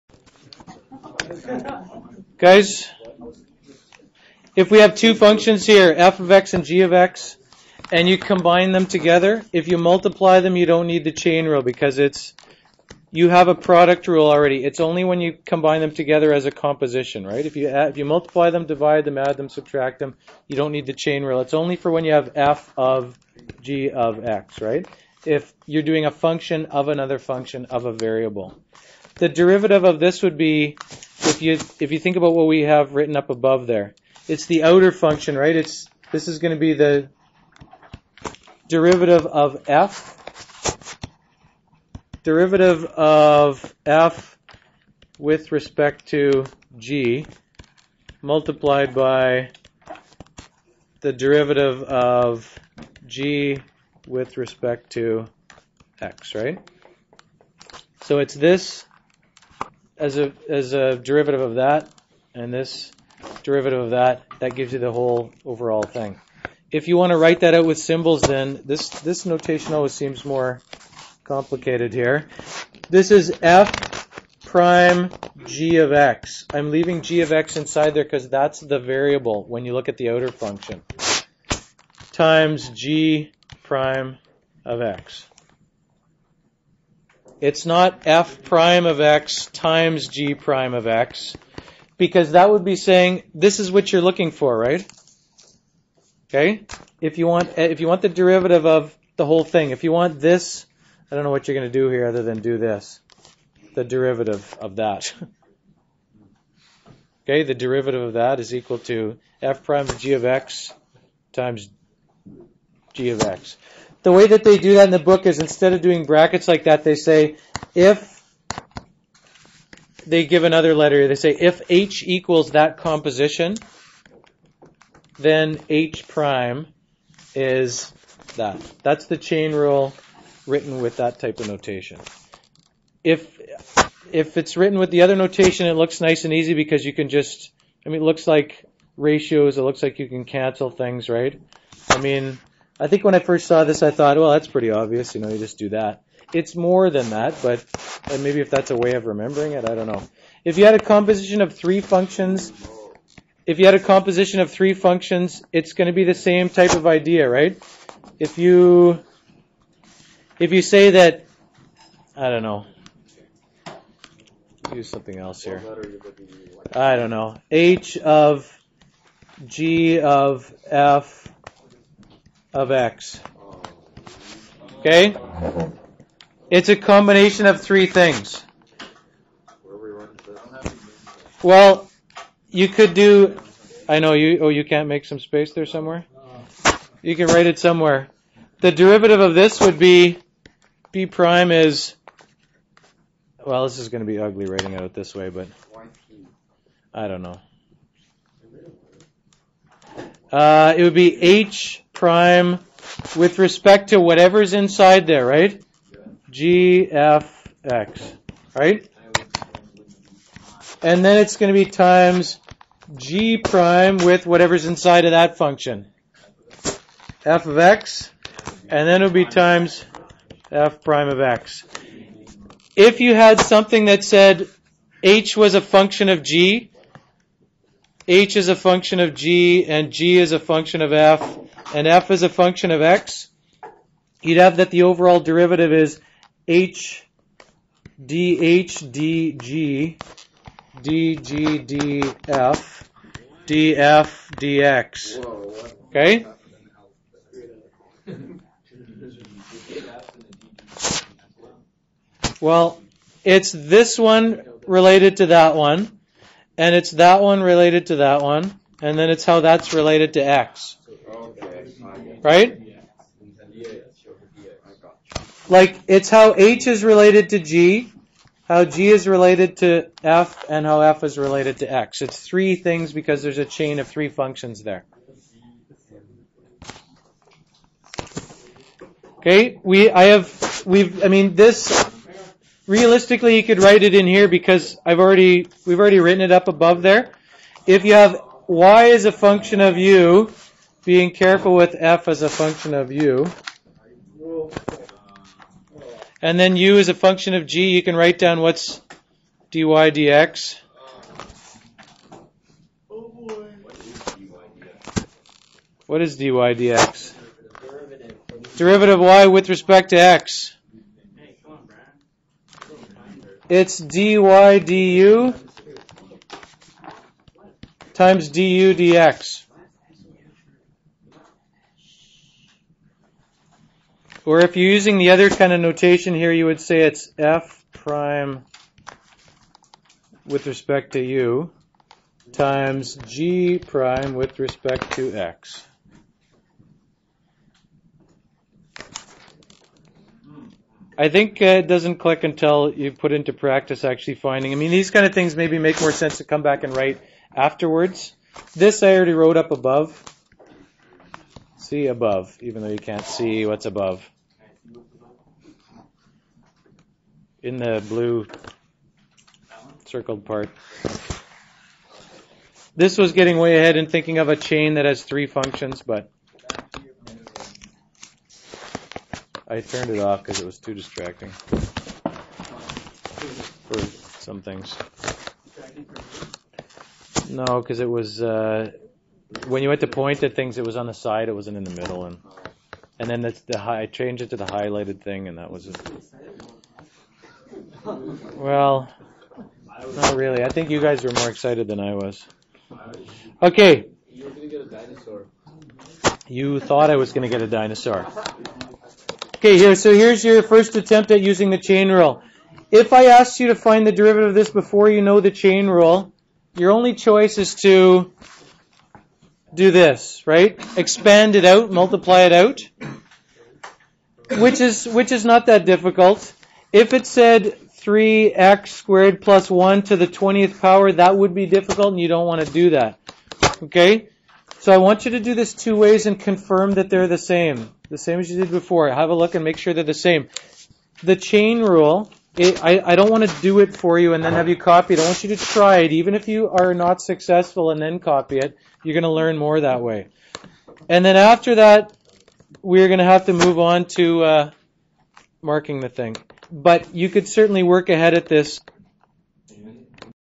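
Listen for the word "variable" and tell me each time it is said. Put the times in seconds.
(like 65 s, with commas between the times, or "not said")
27 s, 78 s.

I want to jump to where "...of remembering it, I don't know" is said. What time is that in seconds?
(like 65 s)
148 s.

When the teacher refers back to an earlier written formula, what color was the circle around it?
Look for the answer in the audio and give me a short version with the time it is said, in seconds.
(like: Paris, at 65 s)
blue, at 357 s.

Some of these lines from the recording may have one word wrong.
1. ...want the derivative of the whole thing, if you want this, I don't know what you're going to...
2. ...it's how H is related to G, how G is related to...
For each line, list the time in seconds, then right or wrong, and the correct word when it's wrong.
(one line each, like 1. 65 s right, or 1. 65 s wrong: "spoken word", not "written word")
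1. 97 s right
2. 265 s right.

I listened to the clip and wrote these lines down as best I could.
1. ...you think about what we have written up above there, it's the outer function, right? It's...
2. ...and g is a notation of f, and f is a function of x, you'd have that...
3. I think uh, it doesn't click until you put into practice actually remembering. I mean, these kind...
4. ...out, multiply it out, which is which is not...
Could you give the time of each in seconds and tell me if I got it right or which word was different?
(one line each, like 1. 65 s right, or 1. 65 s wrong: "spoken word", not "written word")
1. 31 s right
2. 229 s wrong: "function", not "notation"
3. 340 s wrong: "finding", not "remembering"
4. 411 s right.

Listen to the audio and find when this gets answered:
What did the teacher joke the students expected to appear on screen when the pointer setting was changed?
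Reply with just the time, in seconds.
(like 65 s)
397 s.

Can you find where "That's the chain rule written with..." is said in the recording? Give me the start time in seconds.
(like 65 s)
128 s.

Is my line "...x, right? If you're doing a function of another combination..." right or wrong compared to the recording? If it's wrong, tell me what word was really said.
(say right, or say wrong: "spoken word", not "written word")
wrong: "function", not "combination".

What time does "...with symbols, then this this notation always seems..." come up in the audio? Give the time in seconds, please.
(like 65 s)
67 s.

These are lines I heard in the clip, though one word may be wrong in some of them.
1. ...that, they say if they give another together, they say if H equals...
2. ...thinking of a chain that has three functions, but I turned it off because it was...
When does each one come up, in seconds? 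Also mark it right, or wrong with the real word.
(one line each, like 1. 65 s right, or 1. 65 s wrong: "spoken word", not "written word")
1. 116 s wrong: "letter", not "together"
2. 363 s right.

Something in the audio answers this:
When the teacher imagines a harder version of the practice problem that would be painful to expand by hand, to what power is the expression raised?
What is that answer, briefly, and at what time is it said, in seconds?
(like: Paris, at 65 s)
20th power, at 420 s.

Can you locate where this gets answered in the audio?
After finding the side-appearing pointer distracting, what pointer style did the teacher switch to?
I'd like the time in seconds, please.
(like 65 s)
384 s.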